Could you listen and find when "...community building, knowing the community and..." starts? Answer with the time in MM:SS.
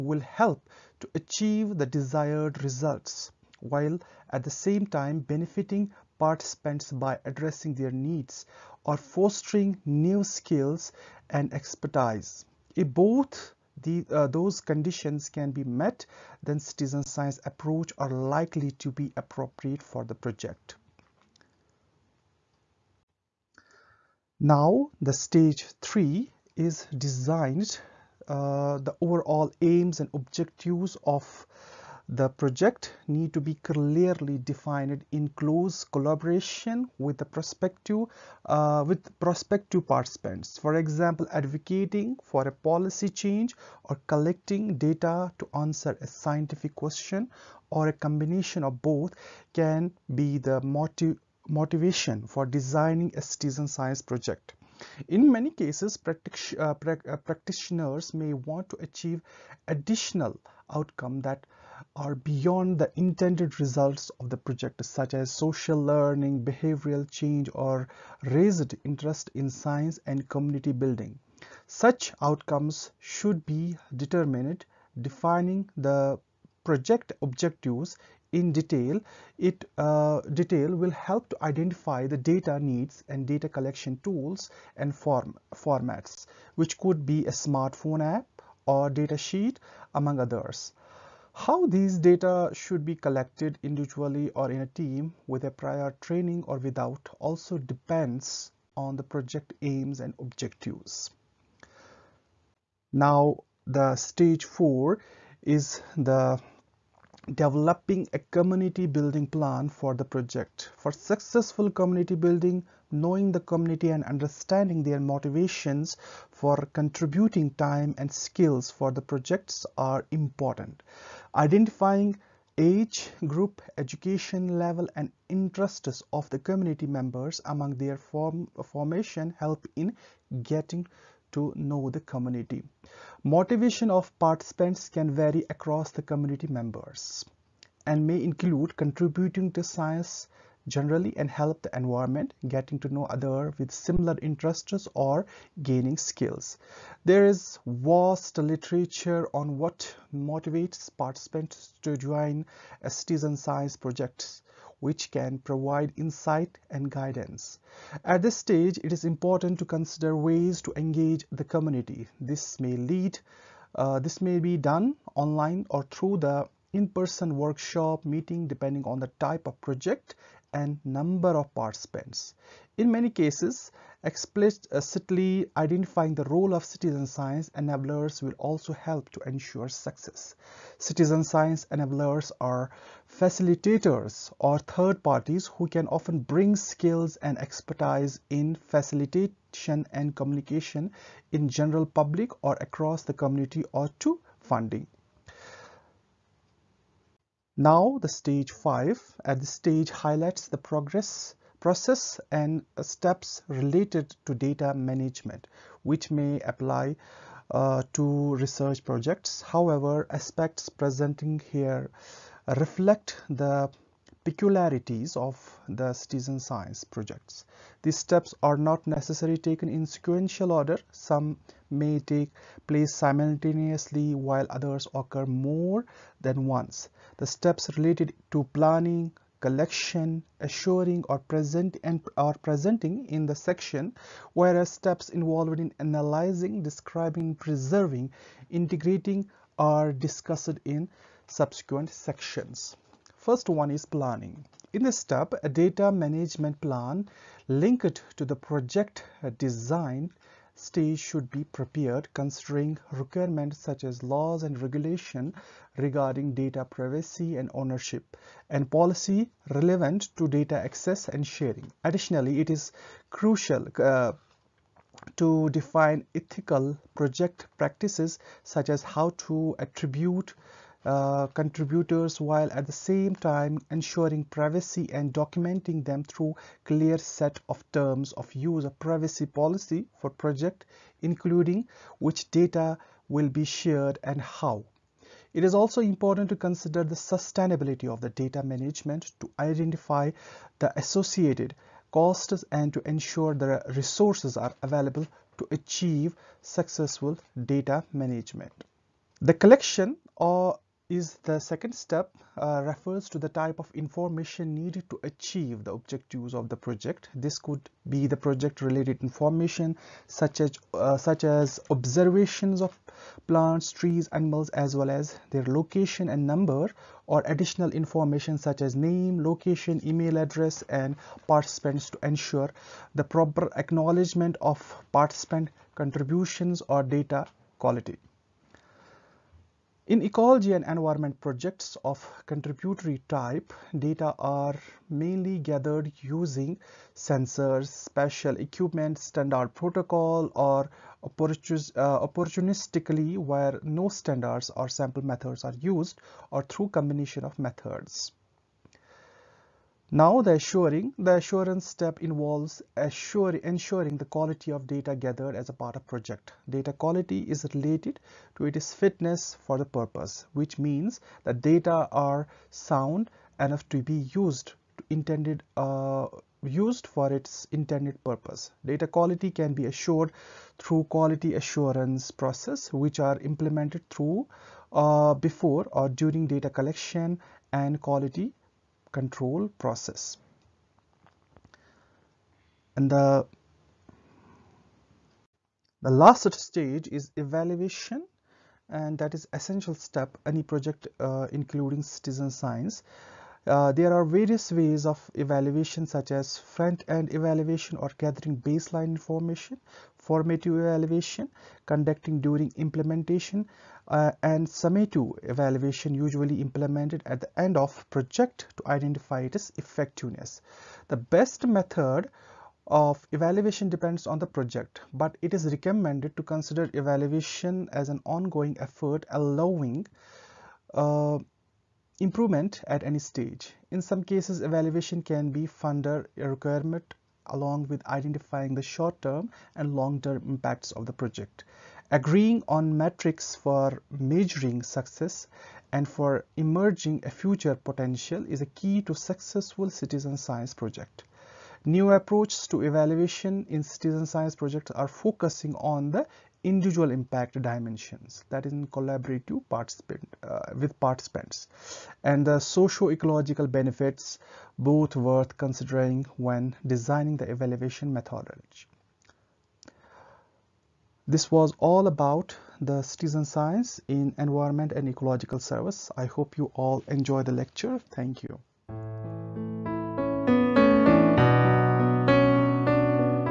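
01:51.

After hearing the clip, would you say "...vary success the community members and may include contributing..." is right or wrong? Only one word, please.
wrong.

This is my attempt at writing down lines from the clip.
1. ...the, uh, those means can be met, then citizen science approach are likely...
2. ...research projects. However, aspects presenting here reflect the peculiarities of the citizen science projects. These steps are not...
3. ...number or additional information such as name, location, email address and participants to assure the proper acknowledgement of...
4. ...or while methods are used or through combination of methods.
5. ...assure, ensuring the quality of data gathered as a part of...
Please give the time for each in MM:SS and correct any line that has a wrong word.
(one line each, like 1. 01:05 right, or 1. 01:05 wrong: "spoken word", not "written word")
1. 00:13 wrong: "conditions", not "means"
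2. 03:28 right
3. 05:16 wrong: "ensure", not "assure"
4. 05:44 wrong: "sample", not "while"
5. 05:52 right.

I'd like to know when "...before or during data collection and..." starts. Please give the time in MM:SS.
06:15.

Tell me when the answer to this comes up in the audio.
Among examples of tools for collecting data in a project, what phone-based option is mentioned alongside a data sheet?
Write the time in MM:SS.
01:27.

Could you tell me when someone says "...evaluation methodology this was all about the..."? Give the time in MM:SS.
07:37.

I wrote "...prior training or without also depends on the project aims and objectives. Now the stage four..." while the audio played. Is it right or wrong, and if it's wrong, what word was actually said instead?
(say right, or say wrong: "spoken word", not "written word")
right.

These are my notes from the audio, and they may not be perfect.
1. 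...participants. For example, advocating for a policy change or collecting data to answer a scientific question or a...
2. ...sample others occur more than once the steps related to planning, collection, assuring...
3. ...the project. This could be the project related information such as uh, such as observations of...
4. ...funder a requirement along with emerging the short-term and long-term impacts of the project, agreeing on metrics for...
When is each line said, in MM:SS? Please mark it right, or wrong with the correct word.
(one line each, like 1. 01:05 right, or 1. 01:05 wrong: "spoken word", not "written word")
1. 00:39 right
2. 03:44 wrong: "while", not "sample"
3. 05:06 right
4. 07:05 wrong: "identifying", not "emerging".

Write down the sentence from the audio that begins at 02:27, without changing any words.
There is vast literature on what motivates participants to join citizen science projects which can provide insight and guidance.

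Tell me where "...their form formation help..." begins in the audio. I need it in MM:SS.
02:07.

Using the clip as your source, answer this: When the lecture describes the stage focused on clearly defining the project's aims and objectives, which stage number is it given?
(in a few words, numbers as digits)
Stage 3.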